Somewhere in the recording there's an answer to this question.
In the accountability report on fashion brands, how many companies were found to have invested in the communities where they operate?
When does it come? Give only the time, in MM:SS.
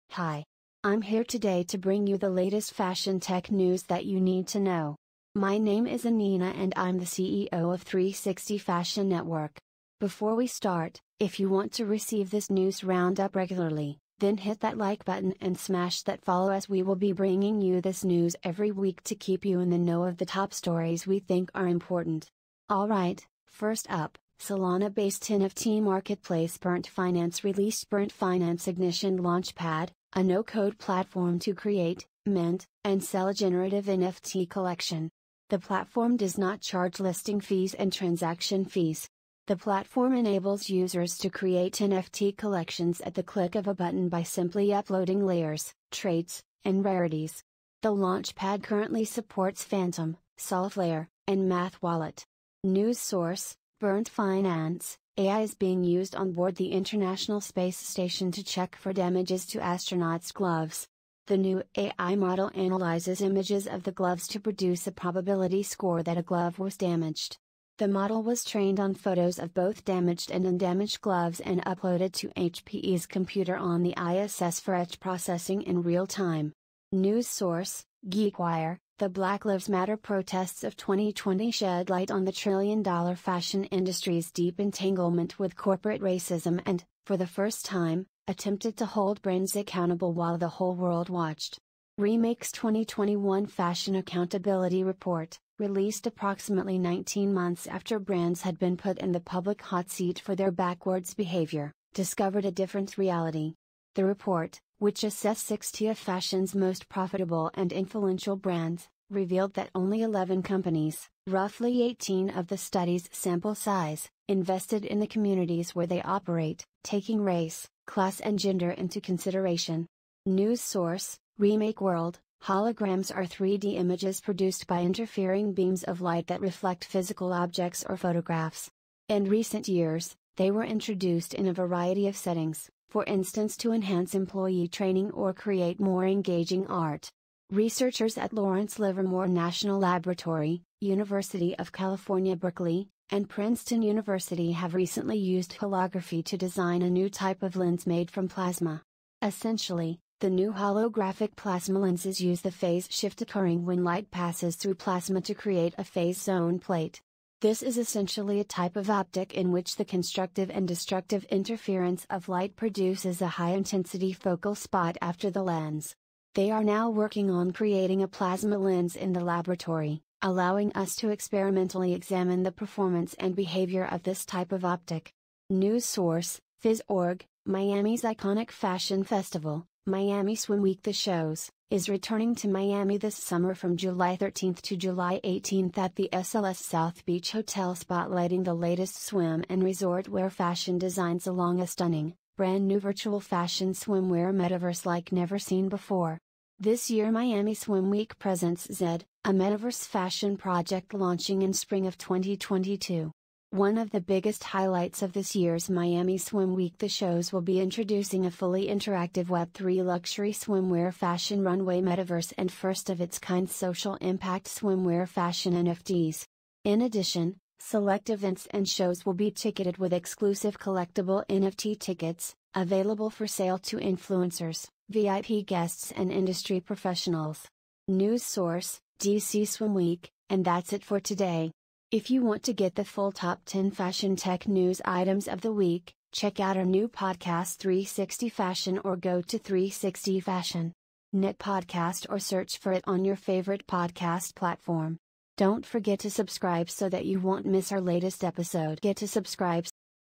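01:50.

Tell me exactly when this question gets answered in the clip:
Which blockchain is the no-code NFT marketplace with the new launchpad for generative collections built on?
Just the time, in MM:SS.
00:24.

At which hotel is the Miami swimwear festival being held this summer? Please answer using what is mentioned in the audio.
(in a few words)
SLS South Beach.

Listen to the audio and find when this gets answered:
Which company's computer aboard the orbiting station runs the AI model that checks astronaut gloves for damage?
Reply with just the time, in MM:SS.
01:12.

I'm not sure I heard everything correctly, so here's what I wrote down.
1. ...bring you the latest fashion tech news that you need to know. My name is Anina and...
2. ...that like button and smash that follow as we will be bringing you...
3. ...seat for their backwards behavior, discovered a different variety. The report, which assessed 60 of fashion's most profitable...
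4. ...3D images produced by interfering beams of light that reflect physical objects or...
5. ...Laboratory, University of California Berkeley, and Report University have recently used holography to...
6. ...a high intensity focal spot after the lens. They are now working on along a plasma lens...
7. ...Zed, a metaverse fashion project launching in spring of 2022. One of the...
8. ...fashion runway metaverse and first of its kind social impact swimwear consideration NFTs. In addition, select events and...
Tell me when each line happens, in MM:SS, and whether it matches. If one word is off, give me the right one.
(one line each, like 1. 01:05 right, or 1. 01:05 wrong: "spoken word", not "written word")
1. 00:01 right
2. 00:14 right
3. 01:39 wrong: "reality", not "variety"
4. 02:03 right
5. 02:19 wrong: "Princeton", not "Report"
6. 02:43 wrong: "creating", not "along"
7. 03:18 right
8. 03:30 wrong: "fashion", not "consideration".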